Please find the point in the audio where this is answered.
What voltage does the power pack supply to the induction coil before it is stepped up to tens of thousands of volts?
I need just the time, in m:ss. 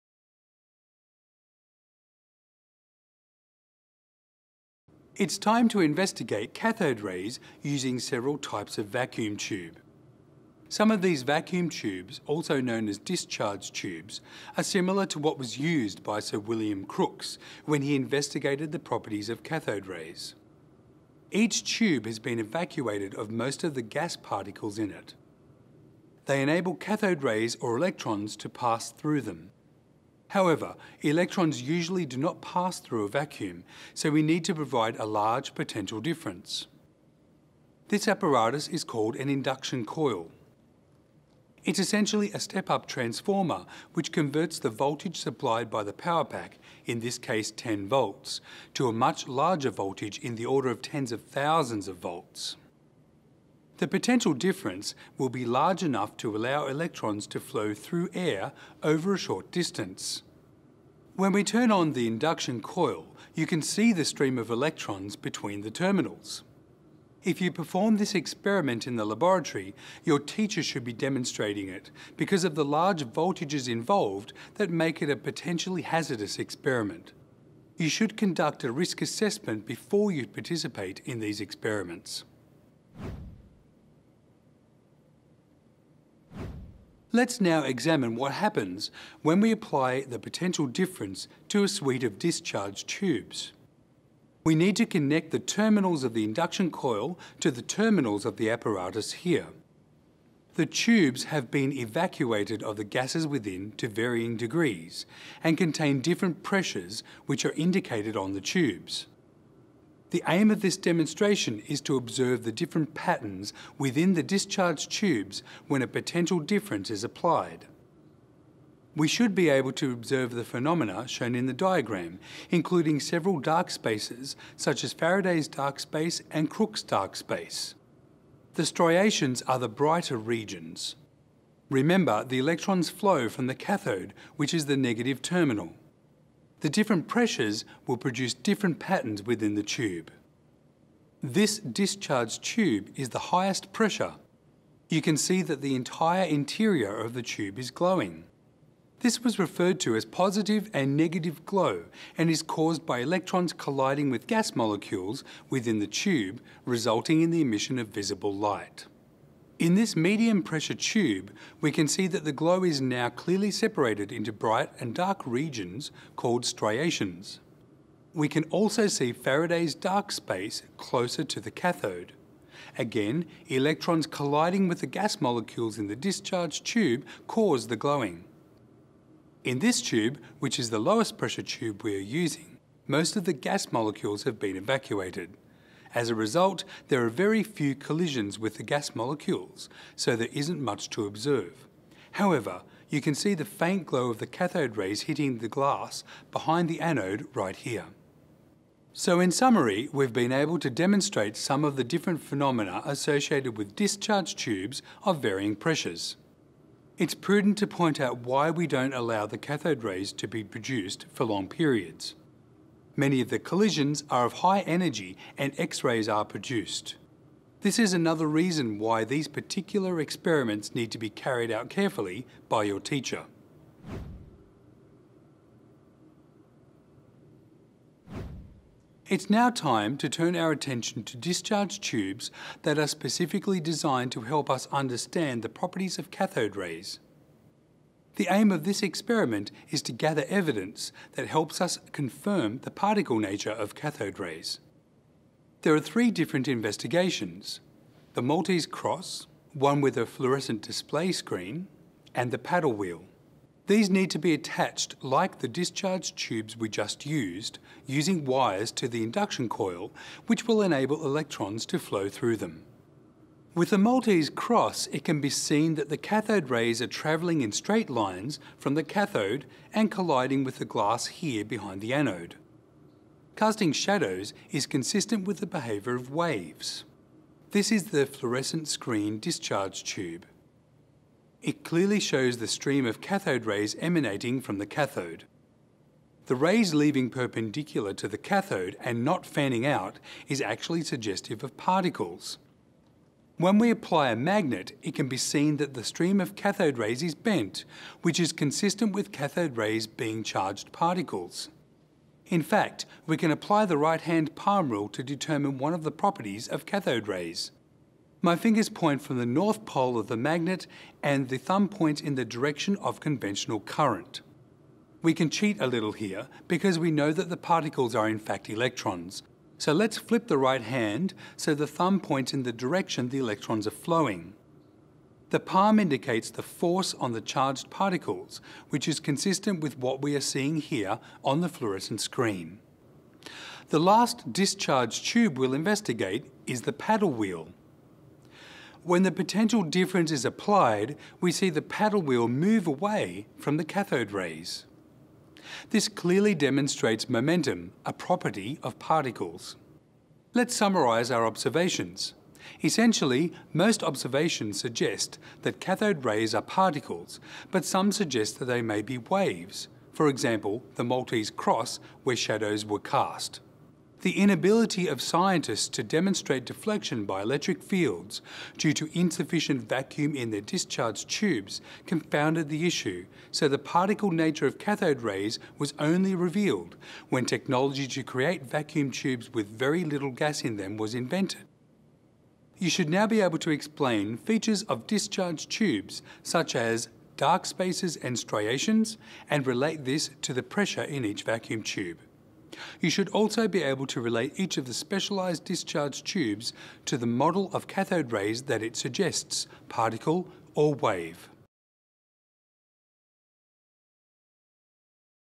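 0:47.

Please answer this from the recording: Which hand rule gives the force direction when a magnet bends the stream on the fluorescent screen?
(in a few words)
right-hand palm rule.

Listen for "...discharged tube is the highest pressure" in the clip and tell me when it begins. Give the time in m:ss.
2:21.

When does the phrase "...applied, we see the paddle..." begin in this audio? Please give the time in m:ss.
5:40.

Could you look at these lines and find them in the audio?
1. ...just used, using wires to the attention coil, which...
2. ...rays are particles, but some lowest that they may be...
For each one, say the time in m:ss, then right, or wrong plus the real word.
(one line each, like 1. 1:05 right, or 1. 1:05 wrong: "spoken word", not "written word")
1. 4:16 wrong: "induction", not "attention"
2. 5:56 wrong: "suggest", not "lowest".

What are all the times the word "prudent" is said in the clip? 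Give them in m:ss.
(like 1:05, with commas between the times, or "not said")
3:27.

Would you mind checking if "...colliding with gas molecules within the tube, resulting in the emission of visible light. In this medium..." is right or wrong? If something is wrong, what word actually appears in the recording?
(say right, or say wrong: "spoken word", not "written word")
right.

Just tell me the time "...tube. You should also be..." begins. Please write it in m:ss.
6:31.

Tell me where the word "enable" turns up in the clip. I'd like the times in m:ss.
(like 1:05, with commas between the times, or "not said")
0:26, 4:20.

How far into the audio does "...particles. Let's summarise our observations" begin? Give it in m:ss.
5:48.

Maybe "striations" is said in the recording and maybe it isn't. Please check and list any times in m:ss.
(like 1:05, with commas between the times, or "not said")
2:08, 2:46, 6:28.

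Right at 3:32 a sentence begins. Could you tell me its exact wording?
Many of the collisions are of high energy and X-rays are produced.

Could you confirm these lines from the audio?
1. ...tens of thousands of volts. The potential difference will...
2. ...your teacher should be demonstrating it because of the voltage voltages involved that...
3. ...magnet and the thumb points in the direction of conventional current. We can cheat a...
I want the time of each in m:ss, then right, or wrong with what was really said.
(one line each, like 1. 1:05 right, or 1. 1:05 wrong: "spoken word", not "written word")
1. 0:50 right
2. 1:10 wrong: "large", not "voltage"
3. 5:10 right.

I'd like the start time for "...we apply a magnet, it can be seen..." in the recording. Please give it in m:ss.
4:53.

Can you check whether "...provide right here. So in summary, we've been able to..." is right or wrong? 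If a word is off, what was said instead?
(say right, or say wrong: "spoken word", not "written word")
wrong: "anode", not "provide".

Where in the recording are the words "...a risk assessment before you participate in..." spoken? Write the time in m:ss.
1:18.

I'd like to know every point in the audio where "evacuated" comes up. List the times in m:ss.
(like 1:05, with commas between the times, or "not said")
0:22, 1:41, 3:04.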